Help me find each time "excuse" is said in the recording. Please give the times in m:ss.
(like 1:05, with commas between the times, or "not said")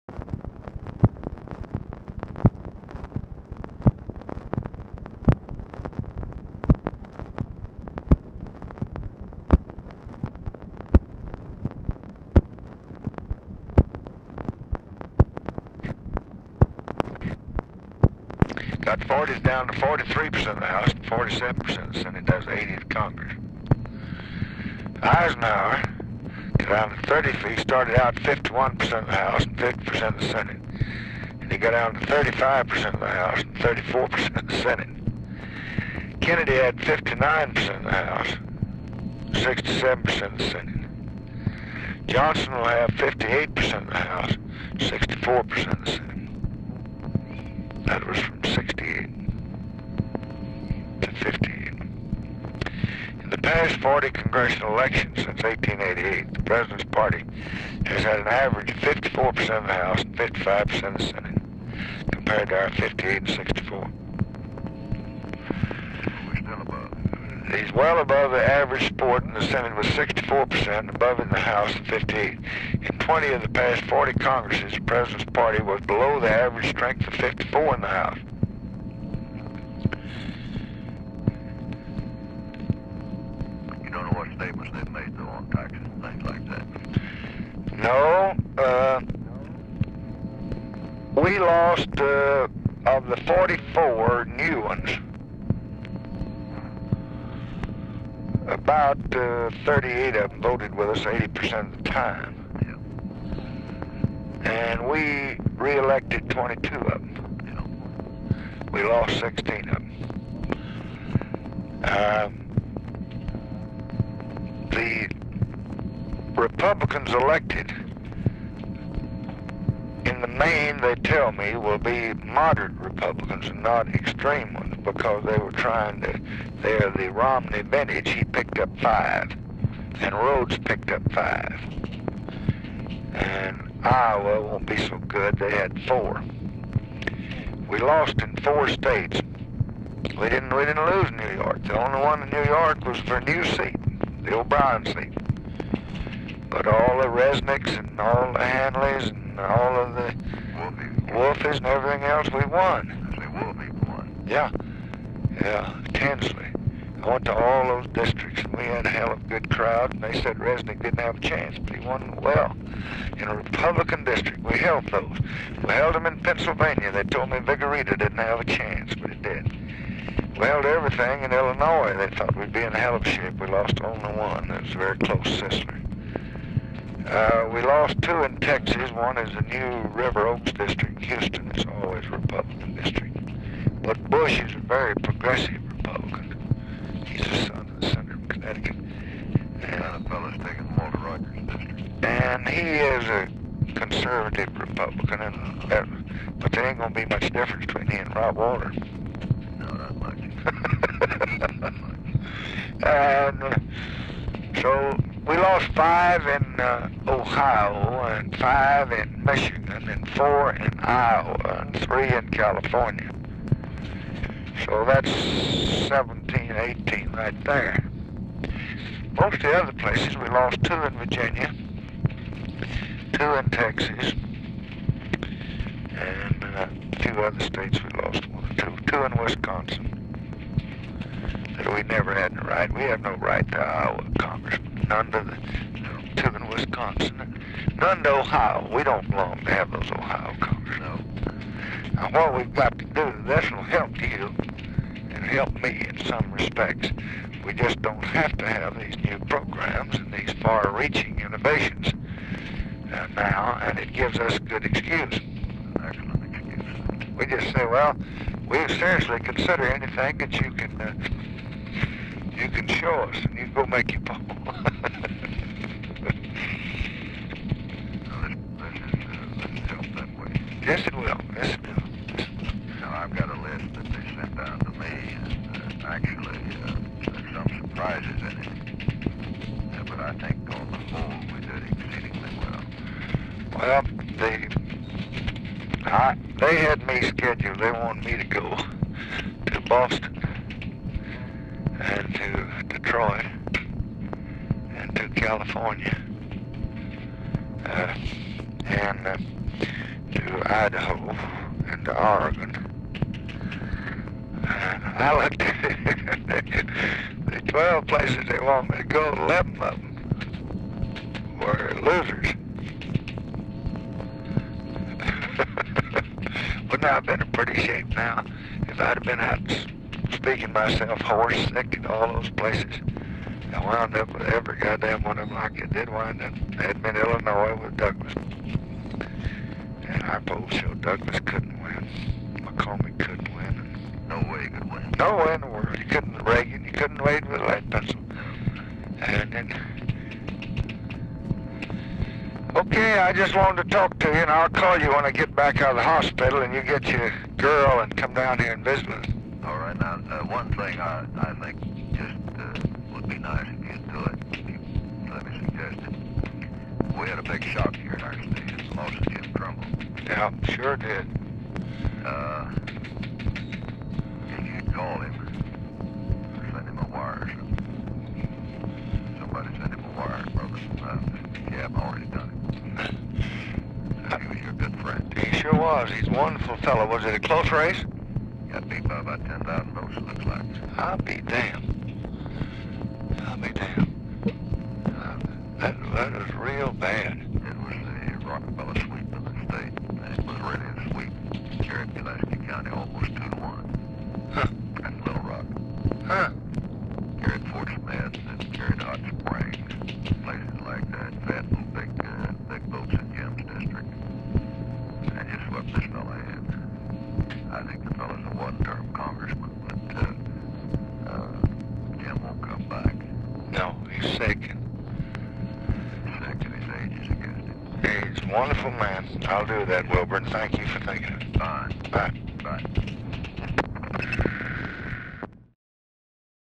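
4:14.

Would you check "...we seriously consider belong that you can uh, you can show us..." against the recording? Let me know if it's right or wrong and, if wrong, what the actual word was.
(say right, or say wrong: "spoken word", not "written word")
wrong: "anything", not "belong".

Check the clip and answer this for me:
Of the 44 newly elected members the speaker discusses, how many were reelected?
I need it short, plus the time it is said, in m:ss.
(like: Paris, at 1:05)
22, at 1:46.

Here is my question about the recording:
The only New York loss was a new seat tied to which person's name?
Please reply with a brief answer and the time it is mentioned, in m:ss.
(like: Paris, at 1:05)
O'Brien, at 2:24.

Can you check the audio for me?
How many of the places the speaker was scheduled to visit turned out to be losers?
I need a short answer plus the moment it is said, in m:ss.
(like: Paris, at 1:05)
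11, at 5:09.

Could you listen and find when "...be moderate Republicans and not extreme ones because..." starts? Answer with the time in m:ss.
2:01.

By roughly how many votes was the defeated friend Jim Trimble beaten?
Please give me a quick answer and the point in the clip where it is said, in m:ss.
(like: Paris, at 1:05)
10,000, at 6:19.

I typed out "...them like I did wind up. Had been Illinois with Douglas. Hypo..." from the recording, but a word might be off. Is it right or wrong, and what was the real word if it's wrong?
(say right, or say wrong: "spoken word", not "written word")
right.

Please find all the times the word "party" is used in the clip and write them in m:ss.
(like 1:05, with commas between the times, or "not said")
0:56, 1:15.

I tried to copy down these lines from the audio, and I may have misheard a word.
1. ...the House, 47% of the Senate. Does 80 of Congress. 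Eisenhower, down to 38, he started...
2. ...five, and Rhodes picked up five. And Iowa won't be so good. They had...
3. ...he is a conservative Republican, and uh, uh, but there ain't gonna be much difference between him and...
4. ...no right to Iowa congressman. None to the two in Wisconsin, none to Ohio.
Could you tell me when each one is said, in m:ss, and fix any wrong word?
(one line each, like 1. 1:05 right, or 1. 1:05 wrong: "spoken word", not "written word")
1. 0:20 wrong: "30", not "38"
2. 2:08 right
3. 3:12 right
4. 3:53 right.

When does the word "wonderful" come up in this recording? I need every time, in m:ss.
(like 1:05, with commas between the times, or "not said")
6:16, 6:58.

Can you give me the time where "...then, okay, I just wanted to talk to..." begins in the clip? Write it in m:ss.
5:39.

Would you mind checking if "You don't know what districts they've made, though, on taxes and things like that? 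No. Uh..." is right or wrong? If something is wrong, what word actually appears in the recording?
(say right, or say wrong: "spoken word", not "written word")
wrong: "statements", not "districts".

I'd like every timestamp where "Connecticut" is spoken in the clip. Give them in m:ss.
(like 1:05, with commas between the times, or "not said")
3:08.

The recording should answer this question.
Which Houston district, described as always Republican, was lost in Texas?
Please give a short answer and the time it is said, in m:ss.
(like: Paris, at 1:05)
River Oaks, at 2:59.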